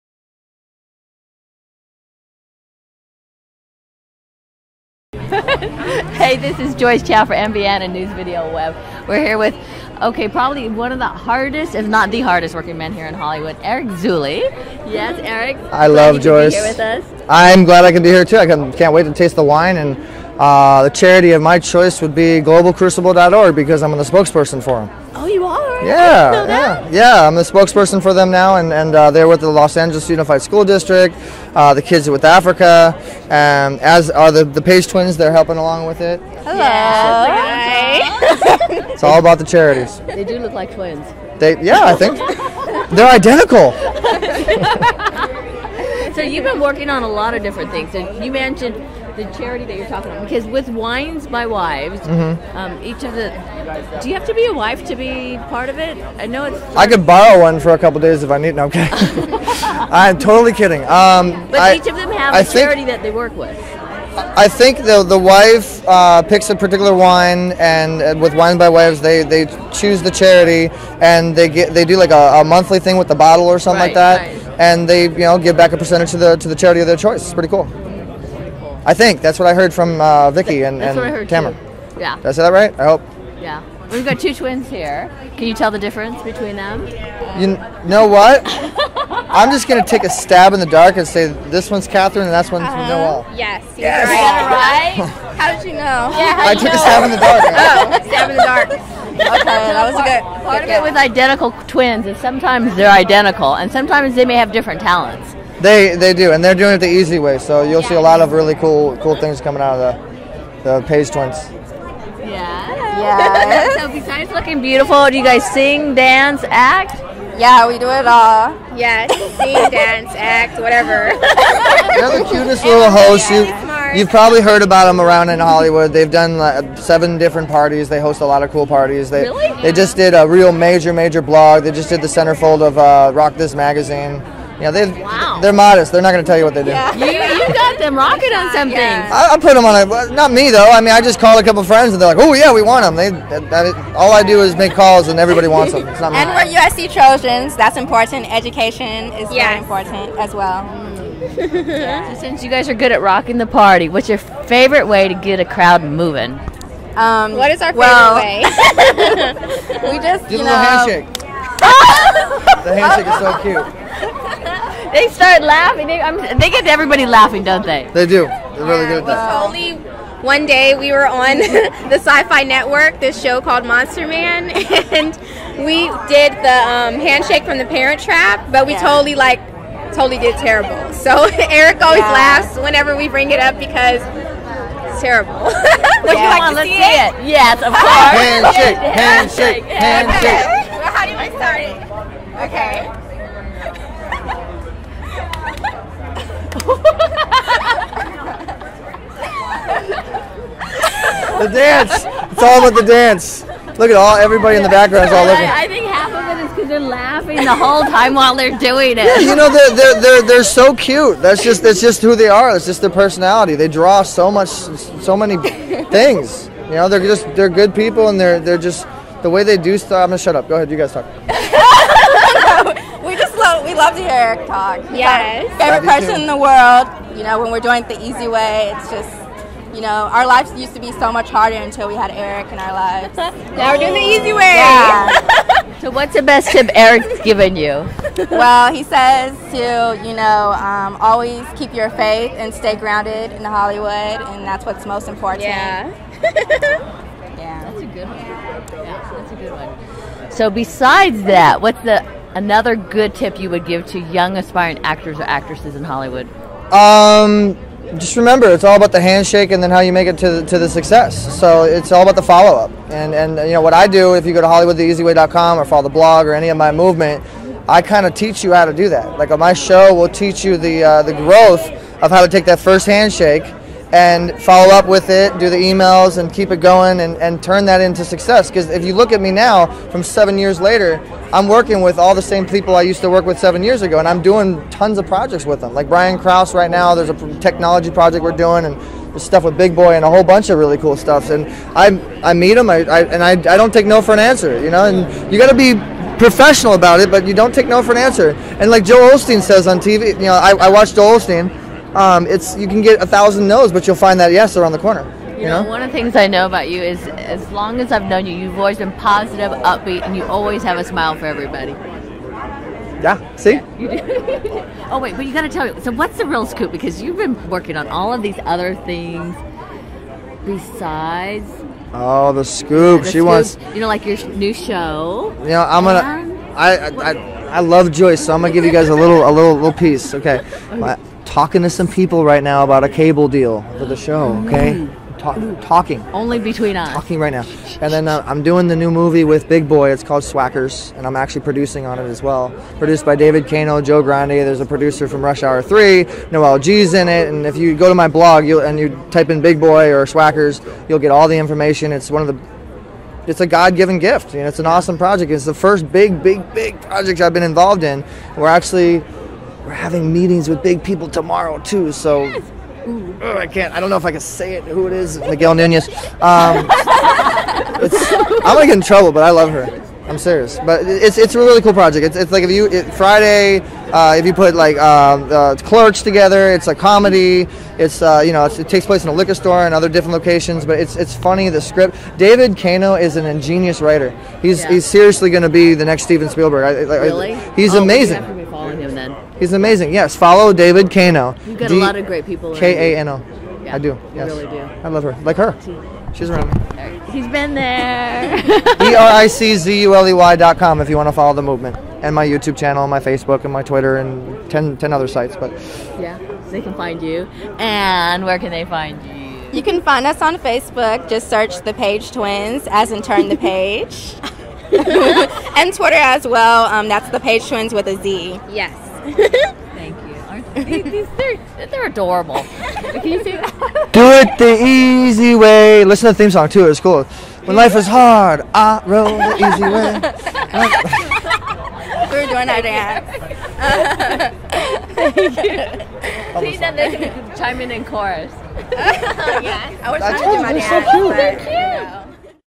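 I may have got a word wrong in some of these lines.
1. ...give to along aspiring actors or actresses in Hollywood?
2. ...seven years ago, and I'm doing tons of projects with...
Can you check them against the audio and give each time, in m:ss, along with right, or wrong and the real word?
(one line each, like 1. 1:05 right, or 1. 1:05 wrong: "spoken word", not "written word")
1. 4:13 wrong: "young", not "along"
2. 4:43 right.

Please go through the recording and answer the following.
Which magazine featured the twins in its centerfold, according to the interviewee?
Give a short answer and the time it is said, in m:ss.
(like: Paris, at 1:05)
Rock This, at 2:13.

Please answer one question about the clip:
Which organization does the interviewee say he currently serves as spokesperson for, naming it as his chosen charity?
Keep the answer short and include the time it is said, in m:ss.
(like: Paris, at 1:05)
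globalcrucible.org, at 0:22.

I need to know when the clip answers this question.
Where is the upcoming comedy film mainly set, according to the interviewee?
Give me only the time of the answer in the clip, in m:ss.
6:19.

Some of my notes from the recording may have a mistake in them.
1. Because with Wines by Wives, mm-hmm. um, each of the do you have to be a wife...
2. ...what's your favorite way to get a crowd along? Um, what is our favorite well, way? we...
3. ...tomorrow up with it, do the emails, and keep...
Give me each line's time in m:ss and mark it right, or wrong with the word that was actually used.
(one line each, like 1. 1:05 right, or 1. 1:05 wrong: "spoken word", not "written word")
1. 0:50 right
2. 2:33 wrong: "moving", not "along"
3. 4:34 wrong: "follow", not "tomorrow".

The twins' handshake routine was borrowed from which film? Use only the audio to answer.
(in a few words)
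The Parent Trap.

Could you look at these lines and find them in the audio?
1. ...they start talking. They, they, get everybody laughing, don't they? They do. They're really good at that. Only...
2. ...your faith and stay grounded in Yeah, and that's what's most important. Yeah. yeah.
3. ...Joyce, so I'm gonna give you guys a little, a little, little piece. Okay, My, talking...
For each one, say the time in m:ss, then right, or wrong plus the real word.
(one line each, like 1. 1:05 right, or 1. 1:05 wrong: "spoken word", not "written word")
1. 2:44 wrong: "laughing", not "talking"
2. 4:01 wrong: "Hollywood", not "Yeah"
3. 5:27 right.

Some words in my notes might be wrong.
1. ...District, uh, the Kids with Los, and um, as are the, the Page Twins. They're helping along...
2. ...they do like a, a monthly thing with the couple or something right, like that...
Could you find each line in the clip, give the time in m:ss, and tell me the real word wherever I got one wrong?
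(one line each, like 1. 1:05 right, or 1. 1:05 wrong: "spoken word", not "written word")
1. 0:30 wrong: "Africa", not "Los"
2. 1:11 wrong: "bottle", not "couple".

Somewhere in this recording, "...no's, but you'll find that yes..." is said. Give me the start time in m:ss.
5:03.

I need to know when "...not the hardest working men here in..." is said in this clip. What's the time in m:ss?
0:11.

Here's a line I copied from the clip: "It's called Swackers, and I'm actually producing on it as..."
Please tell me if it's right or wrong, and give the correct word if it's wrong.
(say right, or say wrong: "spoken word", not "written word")
right.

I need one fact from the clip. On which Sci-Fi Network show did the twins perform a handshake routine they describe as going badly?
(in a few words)
Monster Man.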